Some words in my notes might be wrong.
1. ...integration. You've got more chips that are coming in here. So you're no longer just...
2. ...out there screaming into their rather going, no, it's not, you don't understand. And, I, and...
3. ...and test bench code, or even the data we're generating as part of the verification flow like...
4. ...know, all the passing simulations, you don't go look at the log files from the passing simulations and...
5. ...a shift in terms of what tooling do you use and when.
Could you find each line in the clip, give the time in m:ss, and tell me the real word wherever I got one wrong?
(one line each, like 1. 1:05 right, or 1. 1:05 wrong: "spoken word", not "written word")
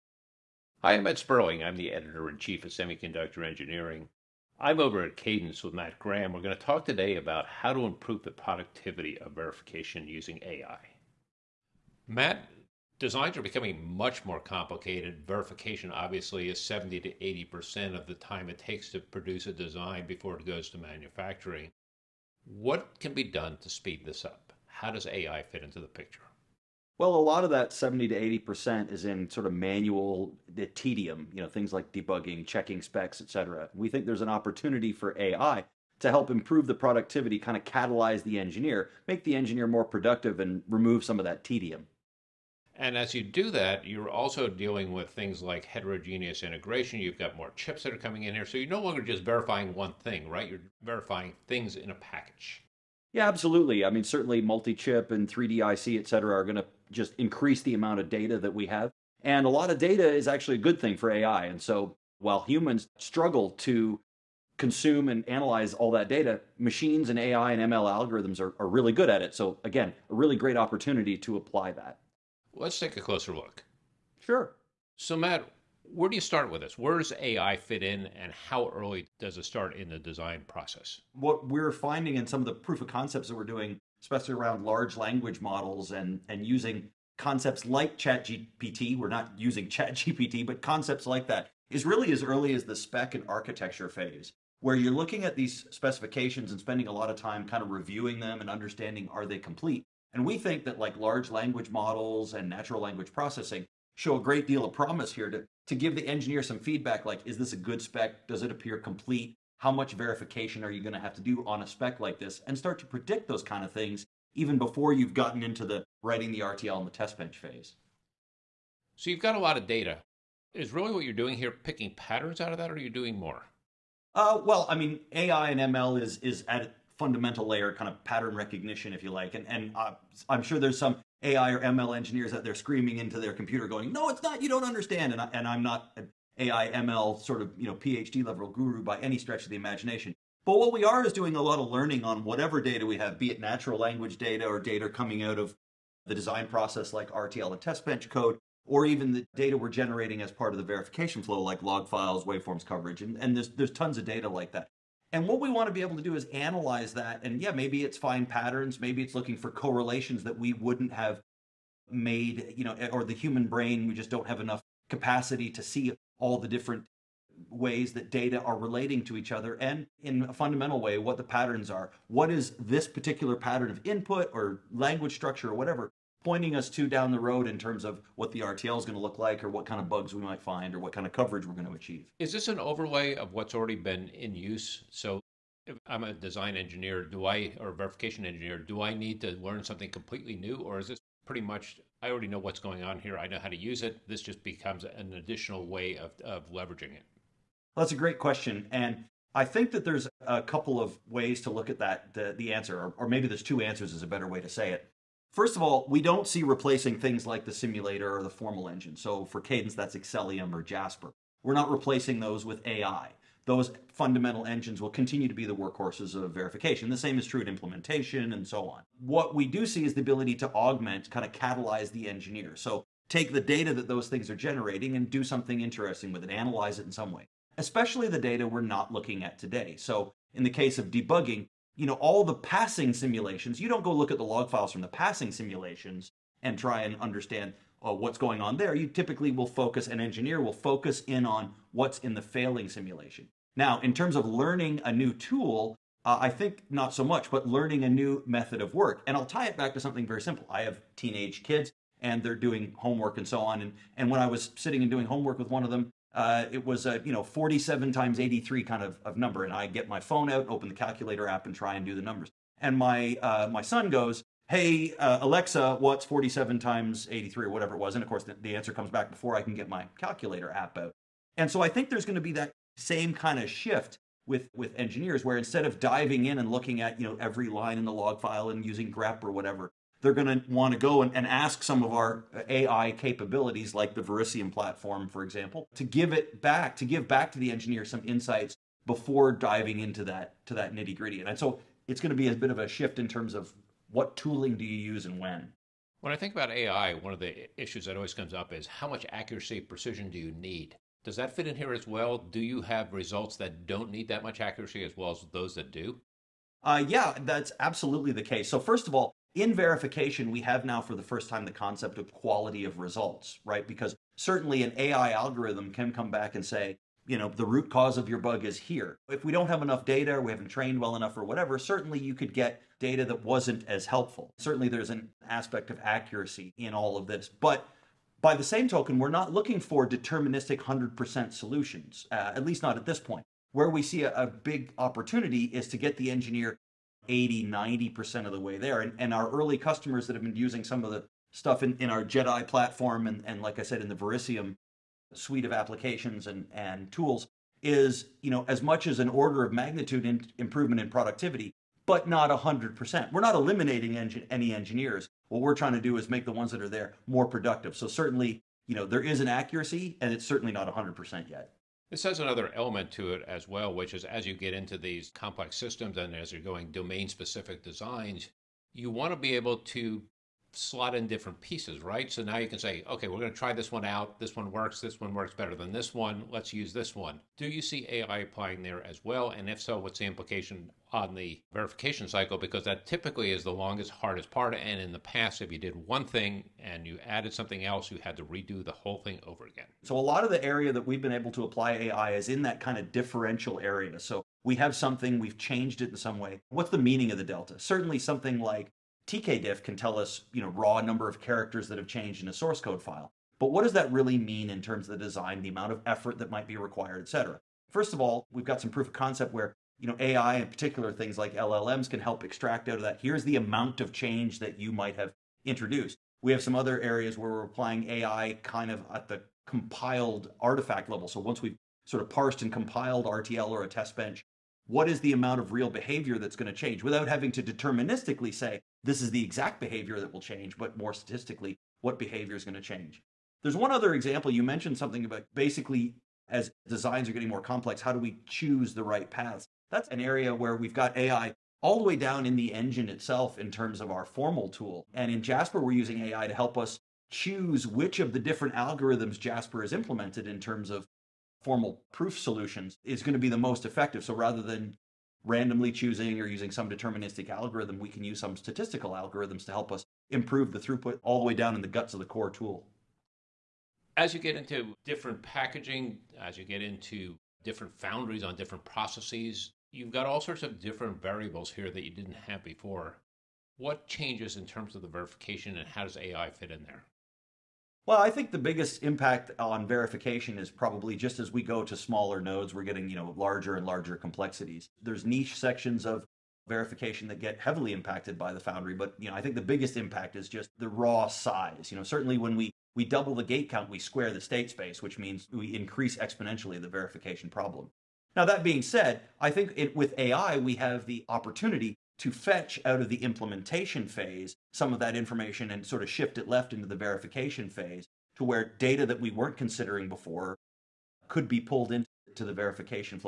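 1. 0:46 right
2. 2:12 wrong: "computer", not "rather"
3. 2:27 right
4. 3:51 right
5. 4:52 right.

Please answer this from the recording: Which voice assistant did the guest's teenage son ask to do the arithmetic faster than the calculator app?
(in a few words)
Alexa.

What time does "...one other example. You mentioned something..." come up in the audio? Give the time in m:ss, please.
7:13.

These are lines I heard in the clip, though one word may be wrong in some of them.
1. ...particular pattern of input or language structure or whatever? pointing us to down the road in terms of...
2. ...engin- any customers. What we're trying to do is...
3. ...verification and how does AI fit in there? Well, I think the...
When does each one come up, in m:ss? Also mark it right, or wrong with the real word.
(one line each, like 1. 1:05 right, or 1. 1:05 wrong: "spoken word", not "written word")
1. 2:52 right
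2. 5:53 wrong: "engineers", not "customers"
3. 7:54 right.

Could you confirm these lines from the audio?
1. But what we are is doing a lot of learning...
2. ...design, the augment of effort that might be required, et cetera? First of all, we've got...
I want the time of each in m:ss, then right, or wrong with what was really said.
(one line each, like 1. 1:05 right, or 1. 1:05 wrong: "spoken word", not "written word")
1. 2:20 right
2. 6:45 wrong: "amount", not "augment".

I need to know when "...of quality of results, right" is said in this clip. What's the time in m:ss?
5:11.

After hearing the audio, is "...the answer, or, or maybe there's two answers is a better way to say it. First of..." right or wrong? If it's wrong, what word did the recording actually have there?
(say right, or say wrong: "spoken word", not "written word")
right.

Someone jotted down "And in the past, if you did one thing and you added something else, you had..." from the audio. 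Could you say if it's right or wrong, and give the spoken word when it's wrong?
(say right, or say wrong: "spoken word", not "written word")
right.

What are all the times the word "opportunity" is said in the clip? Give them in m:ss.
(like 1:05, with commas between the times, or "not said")
0:34, 1:10, 5:34, 8:21.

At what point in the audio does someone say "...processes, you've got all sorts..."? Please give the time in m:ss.
7:48.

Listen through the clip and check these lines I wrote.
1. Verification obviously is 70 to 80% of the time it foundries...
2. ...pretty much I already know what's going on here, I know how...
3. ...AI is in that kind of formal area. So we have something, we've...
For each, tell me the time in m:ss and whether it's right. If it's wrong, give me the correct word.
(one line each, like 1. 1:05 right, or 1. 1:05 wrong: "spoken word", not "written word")
1. 0:15 wrong: "takes", not "foundries"
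2. 3:11 right
3. 6:31 wrong: "differential", not "formal".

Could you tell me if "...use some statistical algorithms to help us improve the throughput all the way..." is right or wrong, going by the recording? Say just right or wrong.
right.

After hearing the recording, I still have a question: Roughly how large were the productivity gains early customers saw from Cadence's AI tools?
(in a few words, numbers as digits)
an order of magnitude.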